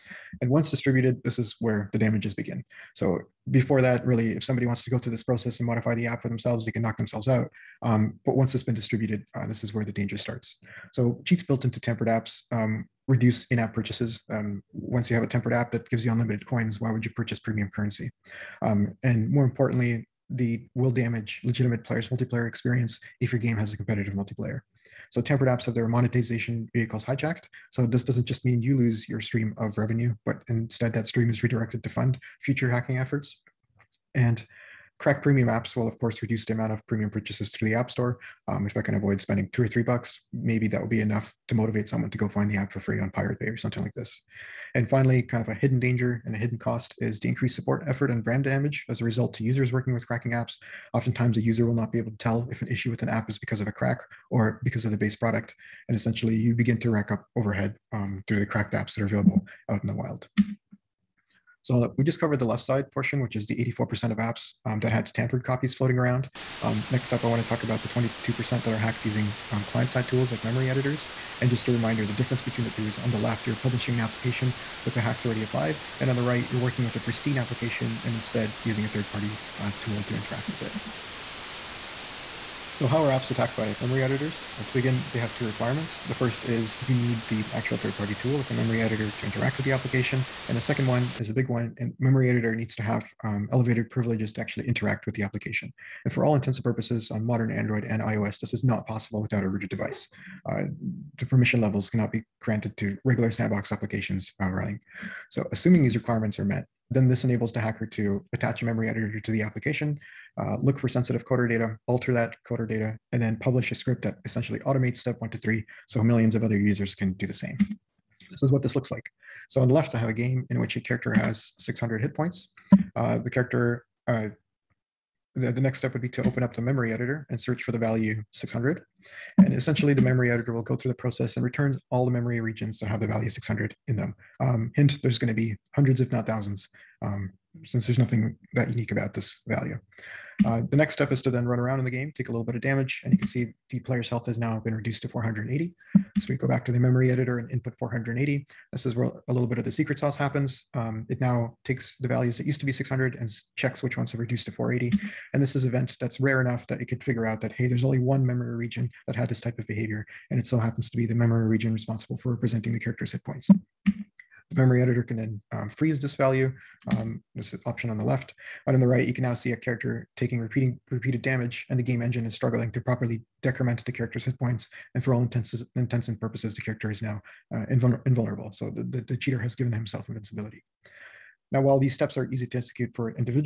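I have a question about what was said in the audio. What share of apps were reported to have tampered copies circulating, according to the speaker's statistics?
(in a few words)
84%.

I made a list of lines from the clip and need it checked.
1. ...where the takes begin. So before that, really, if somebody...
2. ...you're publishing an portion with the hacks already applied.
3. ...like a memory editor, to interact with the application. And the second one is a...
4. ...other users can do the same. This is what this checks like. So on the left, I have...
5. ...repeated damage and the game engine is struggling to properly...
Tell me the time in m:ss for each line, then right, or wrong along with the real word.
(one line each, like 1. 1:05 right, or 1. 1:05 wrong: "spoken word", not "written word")
1. 0:01 wrong: "damages", not "takes"
2. 1:13 wrong: "application", not "portion"
3. 1:28 right
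4. 1:56 wrong: "looks", not "checks"
5. 2:50 right.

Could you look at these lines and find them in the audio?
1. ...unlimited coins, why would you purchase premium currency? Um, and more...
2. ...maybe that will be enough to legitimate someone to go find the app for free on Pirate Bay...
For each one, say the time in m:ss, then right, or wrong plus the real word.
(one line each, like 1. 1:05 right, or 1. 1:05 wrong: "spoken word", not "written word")
1. 0:16 right
2. 0:40 wrong: "motivate", not "legitimate".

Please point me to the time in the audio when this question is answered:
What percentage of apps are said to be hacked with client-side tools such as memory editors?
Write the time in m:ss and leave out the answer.
1:07.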